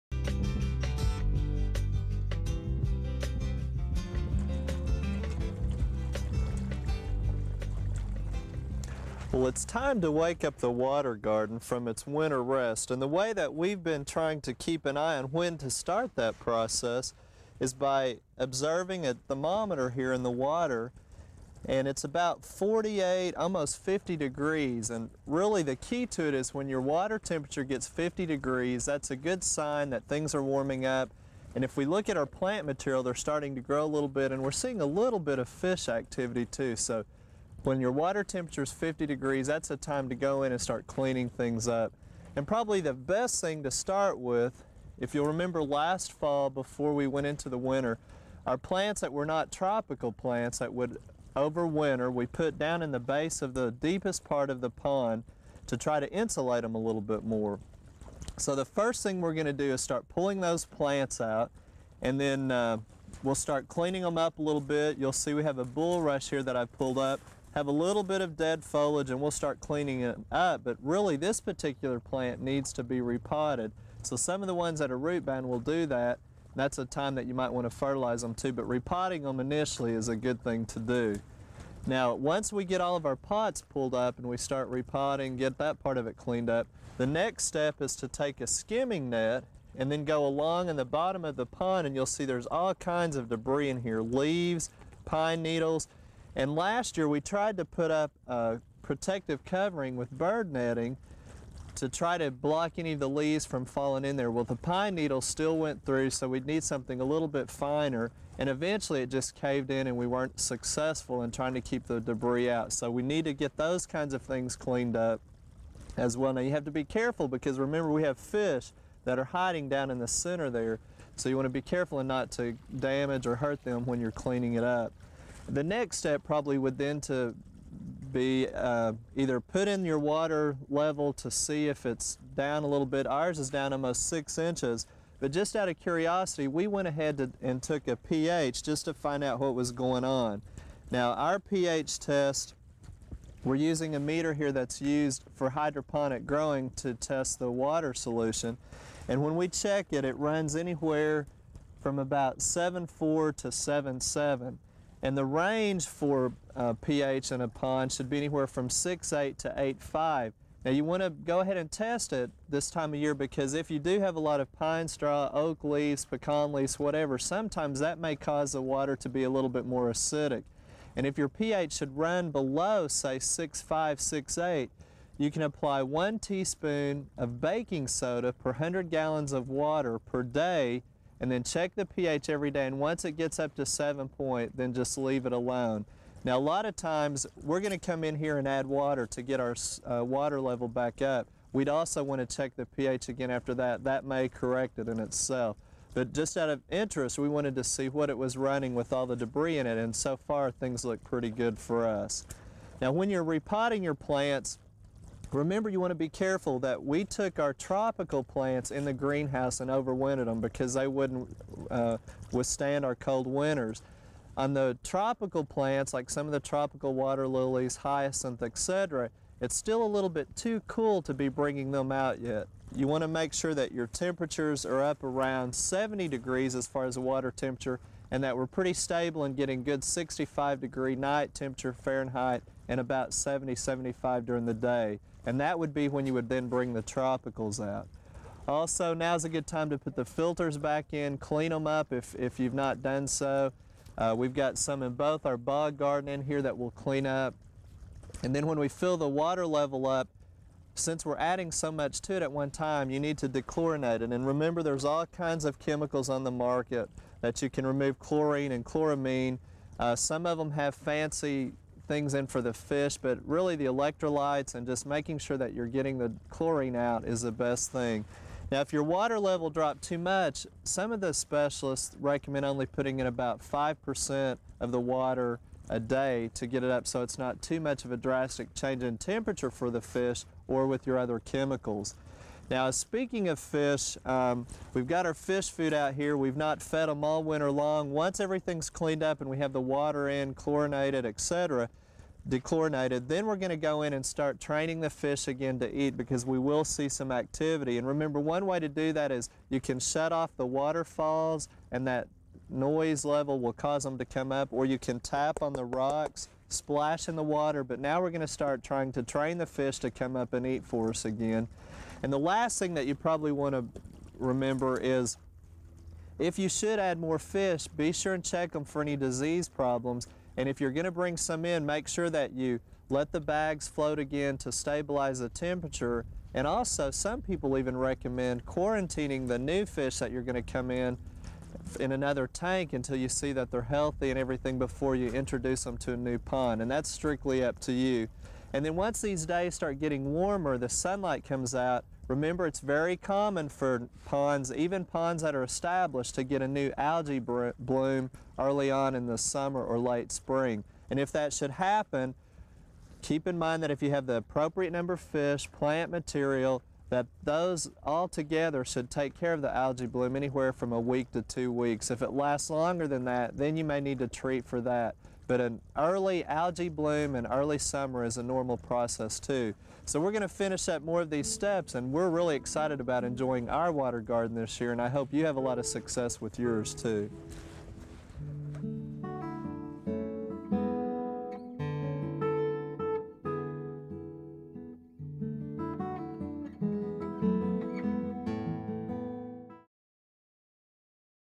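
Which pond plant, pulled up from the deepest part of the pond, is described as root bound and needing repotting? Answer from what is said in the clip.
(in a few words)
bulrush.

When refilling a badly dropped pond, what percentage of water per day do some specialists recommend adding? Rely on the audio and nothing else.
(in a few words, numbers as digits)
5%.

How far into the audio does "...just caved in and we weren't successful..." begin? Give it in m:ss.
1:49.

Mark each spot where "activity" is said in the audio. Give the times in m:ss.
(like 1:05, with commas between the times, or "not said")
0:35, 4:57.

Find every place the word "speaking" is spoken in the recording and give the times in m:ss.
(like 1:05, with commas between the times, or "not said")
4:42.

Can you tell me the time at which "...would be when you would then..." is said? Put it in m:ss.
3:55.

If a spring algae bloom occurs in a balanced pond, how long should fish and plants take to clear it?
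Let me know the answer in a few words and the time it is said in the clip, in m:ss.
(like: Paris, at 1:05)
a week to two weeks, at 6:00.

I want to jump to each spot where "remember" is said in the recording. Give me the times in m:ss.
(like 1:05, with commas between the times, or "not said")
0:45, 1:57, 3:25, 4:14, 4:57, 5:14, 5:42.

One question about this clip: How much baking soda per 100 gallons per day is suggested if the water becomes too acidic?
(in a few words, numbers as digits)
1 teaspoon.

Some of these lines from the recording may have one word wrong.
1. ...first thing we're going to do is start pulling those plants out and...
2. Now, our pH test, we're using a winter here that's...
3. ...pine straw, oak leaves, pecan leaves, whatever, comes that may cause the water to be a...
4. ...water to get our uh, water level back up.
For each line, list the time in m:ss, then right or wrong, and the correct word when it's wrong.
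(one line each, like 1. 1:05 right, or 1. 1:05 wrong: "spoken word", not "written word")
1. 0:58 right
2. 2:20 wrong: "meter", not "winter"
3. 2:44 wrong: "sometimes", not "comes"
4. 3:08 right.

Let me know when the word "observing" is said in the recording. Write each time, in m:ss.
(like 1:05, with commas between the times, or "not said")
0:18.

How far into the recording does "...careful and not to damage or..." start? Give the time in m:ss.
2:01.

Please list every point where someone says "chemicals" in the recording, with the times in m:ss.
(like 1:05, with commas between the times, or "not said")
4:15, 4:41.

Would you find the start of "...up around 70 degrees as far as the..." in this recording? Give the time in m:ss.
3:44.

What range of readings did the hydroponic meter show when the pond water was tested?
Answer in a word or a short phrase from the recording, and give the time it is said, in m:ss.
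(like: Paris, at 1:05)
7.4 to 7.7, at 2:32.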